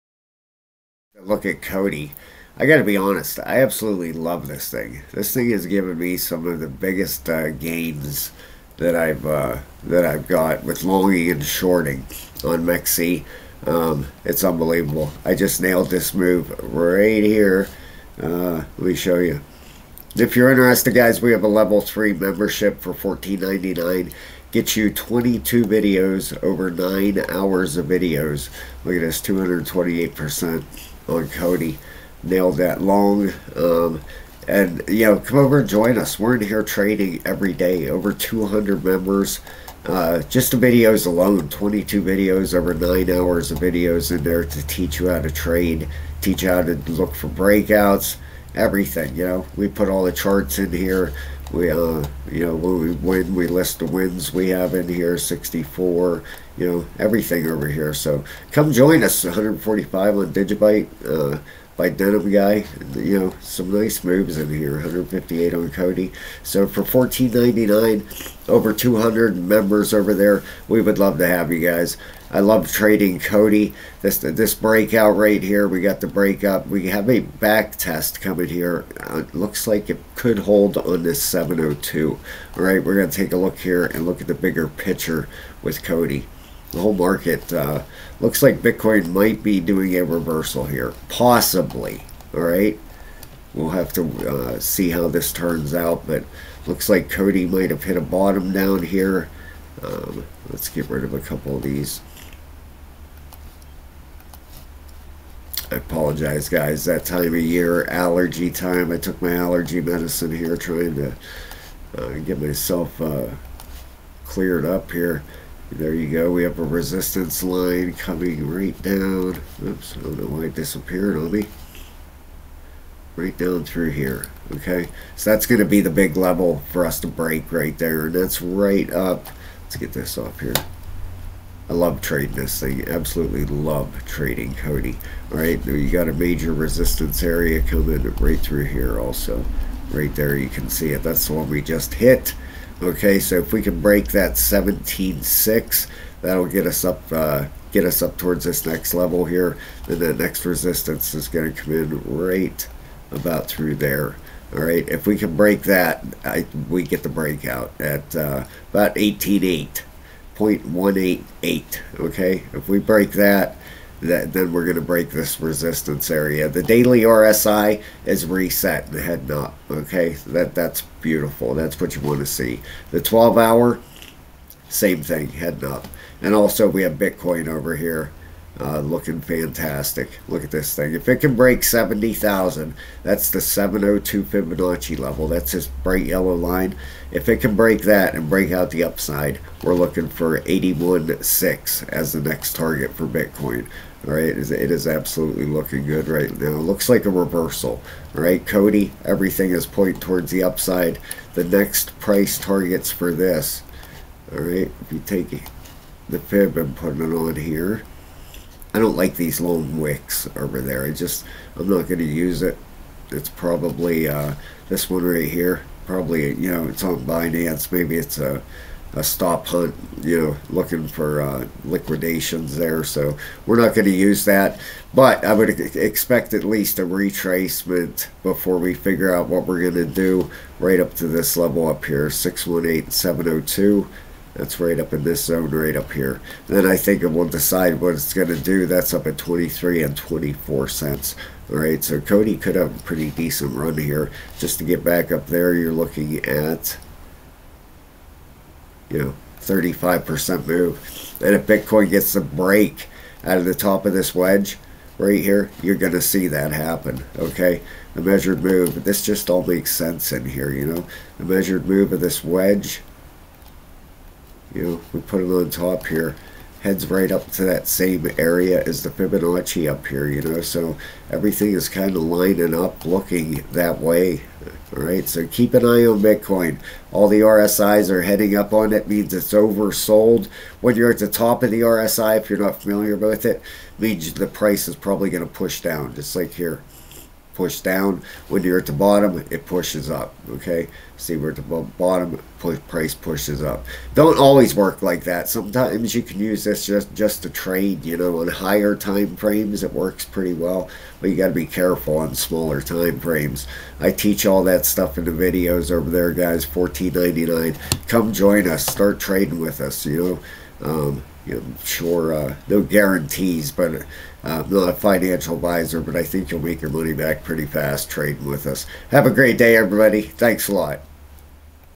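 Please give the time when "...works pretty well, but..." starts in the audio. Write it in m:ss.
4:59.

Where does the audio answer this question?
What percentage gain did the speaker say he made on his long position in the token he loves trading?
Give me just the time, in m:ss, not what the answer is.
0:29.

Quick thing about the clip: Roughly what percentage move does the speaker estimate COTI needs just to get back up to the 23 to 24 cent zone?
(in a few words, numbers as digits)
35%.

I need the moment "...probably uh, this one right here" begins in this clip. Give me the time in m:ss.
3:33.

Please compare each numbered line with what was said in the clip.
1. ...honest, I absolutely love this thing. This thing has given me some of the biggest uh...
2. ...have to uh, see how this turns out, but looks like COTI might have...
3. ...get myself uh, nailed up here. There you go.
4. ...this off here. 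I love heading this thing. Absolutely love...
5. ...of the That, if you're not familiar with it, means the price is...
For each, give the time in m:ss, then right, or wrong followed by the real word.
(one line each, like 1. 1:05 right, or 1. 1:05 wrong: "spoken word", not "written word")
1. 0:02 right
2. 1:33 right
3. 1:52 wrong: "cleared", not "nailed"
4. 2:09 wrong: "trading", not "heading"
5. 4:41 wrong: "RSI", not "That".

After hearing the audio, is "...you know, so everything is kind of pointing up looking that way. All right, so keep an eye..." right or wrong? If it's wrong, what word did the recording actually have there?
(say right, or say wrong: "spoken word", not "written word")
wrong: "lining", not "pointing".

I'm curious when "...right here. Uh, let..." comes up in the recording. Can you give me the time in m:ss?
0:16.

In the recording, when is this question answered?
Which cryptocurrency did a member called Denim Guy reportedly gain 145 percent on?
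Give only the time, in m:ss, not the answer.
1:00.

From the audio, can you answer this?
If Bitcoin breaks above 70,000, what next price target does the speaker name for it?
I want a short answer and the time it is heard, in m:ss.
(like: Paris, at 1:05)
81.6, at 3:10.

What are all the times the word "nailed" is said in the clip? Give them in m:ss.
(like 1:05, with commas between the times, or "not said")
0:15, 0:32.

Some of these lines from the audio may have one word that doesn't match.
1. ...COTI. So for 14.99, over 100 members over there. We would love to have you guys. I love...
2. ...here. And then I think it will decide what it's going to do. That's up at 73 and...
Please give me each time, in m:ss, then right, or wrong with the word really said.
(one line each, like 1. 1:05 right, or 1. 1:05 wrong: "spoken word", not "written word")
1. 1:05 wrong: "200", not "100"
2. 3:55 wrong: "23", not "73".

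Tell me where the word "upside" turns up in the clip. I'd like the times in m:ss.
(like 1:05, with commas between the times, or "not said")
3:08, 3:20.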